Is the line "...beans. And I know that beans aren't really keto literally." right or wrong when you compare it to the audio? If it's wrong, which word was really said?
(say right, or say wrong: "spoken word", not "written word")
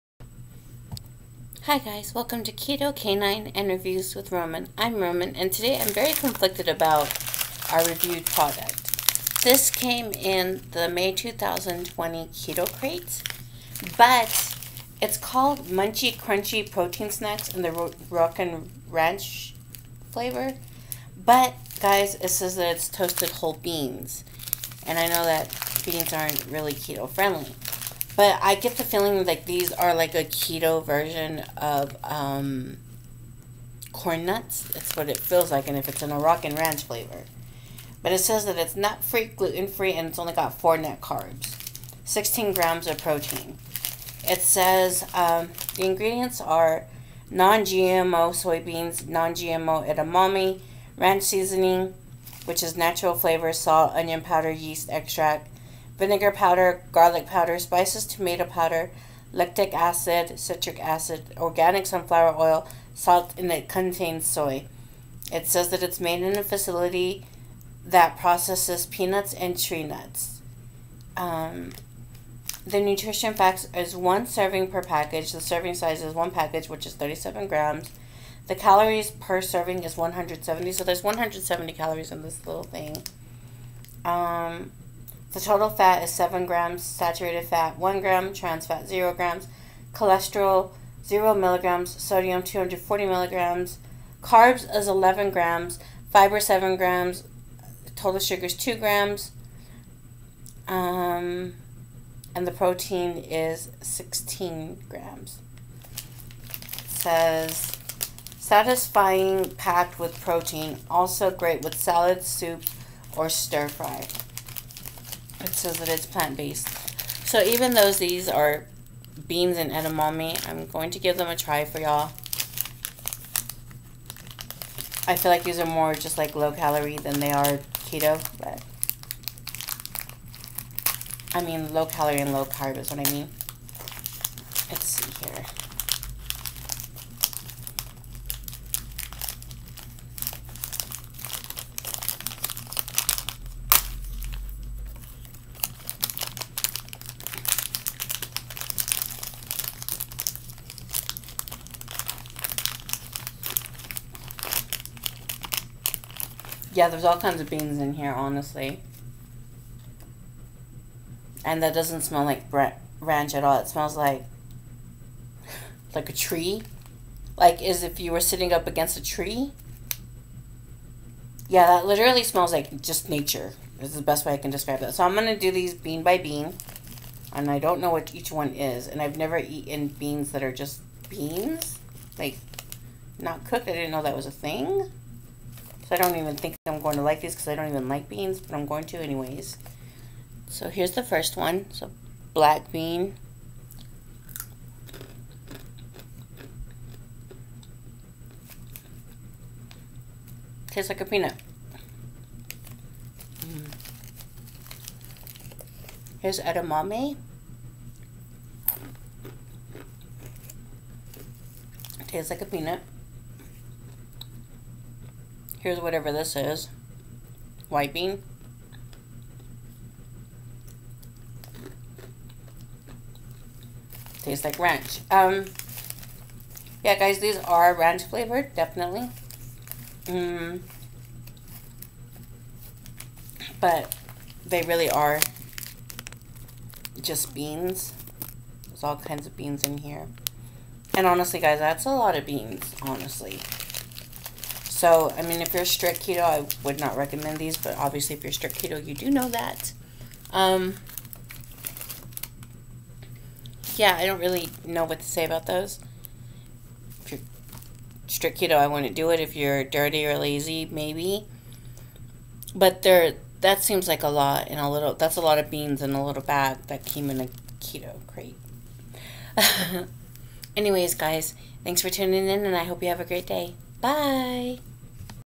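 wrong: "friendly", not "literally".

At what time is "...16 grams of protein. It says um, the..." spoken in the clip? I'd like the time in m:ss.
0:42.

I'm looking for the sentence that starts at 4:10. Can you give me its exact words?
Um, yeah, I don't really know what to say about those.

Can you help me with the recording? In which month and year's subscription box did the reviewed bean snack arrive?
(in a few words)
May 2020.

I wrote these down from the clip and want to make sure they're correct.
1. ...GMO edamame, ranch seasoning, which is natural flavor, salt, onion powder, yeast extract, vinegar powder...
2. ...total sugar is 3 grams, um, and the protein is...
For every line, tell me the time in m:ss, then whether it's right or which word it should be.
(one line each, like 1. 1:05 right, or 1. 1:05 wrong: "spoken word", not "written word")
1. 0:49 right
2. 1:37 wrong: "2", not "3".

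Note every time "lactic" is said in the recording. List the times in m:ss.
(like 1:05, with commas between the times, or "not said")
0:59.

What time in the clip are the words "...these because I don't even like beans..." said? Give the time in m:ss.
3:07.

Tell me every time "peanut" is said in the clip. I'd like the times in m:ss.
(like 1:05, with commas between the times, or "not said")
1:08, 3:21, 3:32.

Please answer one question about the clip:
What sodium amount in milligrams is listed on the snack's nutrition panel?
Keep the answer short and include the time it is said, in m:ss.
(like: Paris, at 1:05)
240 milligrams, at 1:32.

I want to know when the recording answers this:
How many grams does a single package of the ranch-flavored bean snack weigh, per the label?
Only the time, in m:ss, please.
1:16.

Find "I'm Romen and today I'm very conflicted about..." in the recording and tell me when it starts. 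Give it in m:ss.
0:04.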